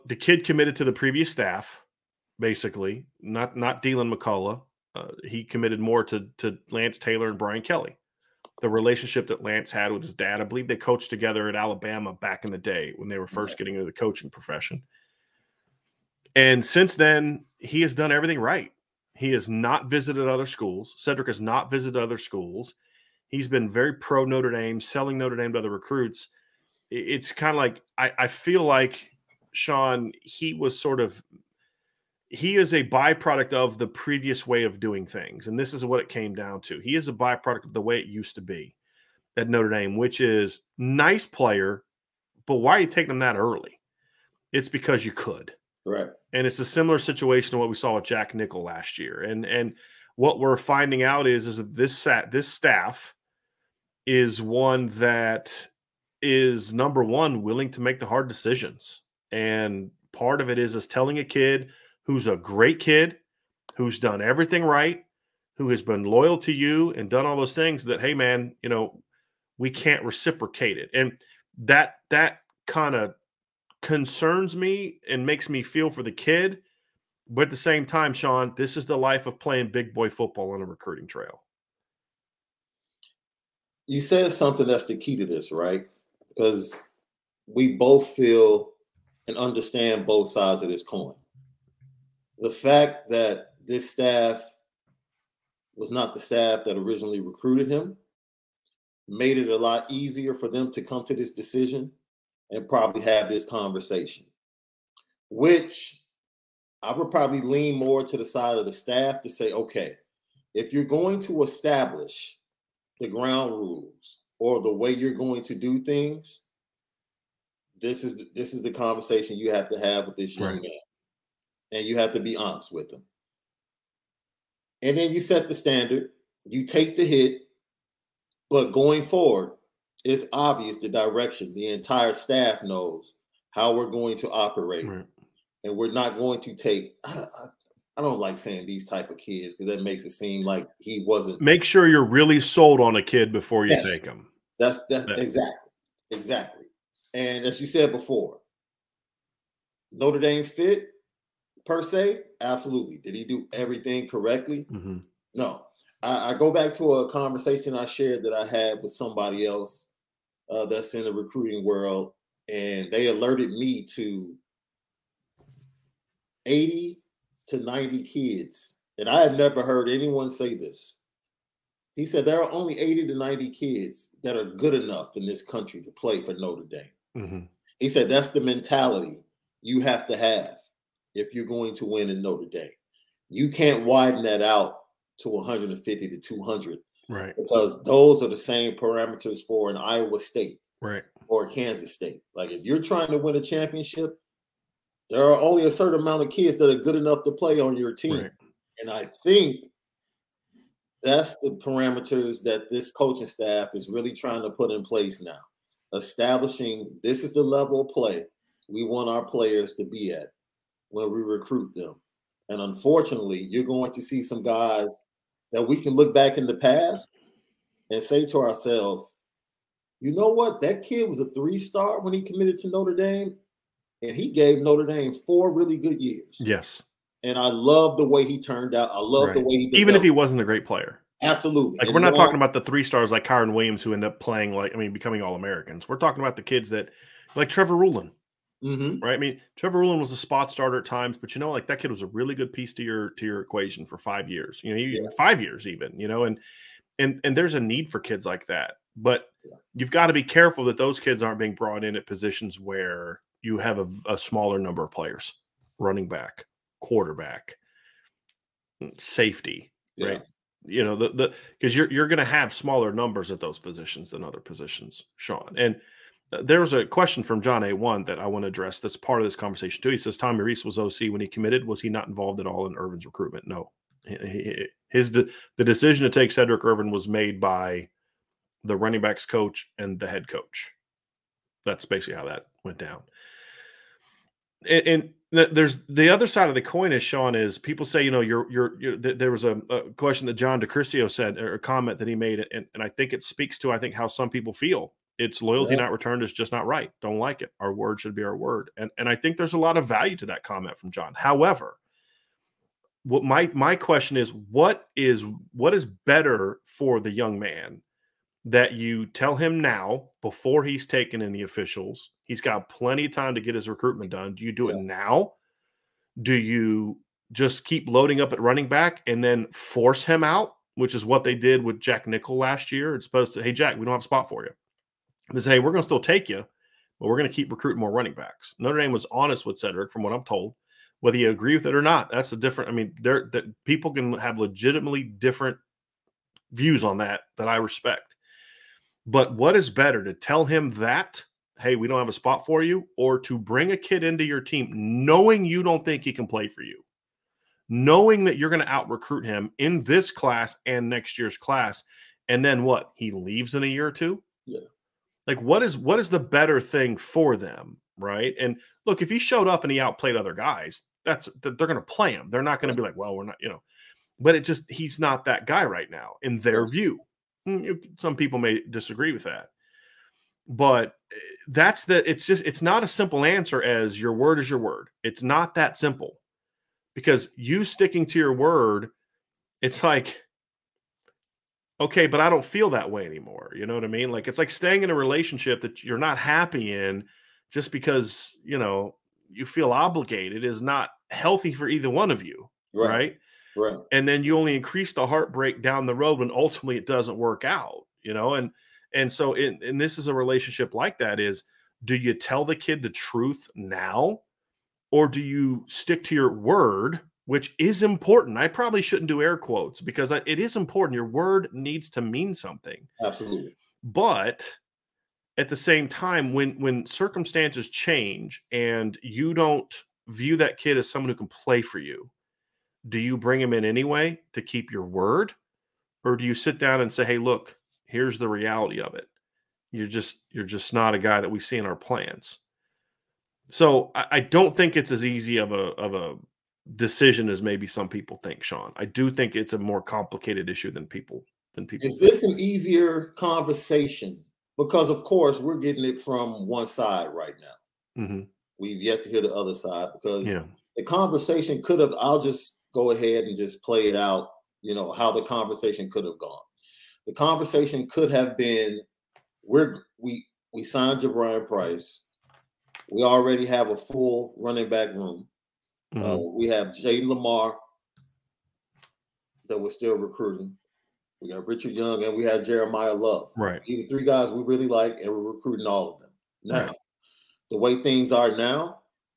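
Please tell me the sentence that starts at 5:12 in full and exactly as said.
He's got plenty of time to get his recruitment done.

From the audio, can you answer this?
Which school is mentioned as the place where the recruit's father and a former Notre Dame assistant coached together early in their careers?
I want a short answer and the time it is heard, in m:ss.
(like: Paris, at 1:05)
Alabama, at 0:11.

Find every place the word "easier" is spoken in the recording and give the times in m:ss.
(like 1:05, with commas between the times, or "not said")
1:39, 7:22.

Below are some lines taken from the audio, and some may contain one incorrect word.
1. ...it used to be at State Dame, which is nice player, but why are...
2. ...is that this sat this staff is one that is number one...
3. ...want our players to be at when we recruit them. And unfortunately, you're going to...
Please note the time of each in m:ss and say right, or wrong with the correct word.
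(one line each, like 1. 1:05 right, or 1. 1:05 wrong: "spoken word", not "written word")
1. 0:37 wrong: "Notre", not "State"
2. 0:51 right
3. 3:28 right.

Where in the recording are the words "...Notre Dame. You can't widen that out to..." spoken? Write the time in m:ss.
3:02.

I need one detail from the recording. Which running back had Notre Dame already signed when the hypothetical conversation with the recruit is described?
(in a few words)
Jadarian Price.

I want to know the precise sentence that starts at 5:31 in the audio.
Whether you agree with it or not, that's a different.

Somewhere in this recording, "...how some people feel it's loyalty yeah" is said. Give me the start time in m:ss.
4:53.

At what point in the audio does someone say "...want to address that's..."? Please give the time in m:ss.
4:28.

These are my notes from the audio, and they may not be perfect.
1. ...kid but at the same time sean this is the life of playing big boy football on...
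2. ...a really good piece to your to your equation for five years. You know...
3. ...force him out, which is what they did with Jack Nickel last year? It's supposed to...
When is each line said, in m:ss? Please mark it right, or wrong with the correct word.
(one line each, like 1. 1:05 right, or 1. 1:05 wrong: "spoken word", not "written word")
1. 1:16 right
2. 4:02 right
3. 5:19 right.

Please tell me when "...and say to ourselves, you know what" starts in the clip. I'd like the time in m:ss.
3:37.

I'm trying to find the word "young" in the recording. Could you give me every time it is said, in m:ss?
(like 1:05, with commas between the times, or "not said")
2:00, 5:07, 7:51.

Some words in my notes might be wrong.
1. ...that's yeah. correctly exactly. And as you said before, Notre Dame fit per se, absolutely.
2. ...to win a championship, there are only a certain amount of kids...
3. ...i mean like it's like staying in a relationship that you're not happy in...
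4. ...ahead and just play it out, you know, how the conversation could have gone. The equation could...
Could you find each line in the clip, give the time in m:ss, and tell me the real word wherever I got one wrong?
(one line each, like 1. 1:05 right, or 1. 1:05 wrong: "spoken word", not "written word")
1. 2:24 wrong: "exactly", not "correctly"
2. 3:13 right
3. 6:23 right
4. 7:32 wrong: "conversation", not "equation".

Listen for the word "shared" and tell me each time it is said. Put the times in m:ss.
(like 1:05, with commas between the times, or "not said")
2:37.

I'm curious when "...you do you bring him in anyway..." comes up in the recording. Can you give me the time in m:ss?
7:01.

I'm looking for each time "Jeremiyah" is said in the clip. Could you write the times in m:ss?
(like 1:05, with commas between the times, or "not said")
7:52.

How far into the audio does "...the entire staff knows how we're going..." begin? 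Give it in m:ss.
2:11.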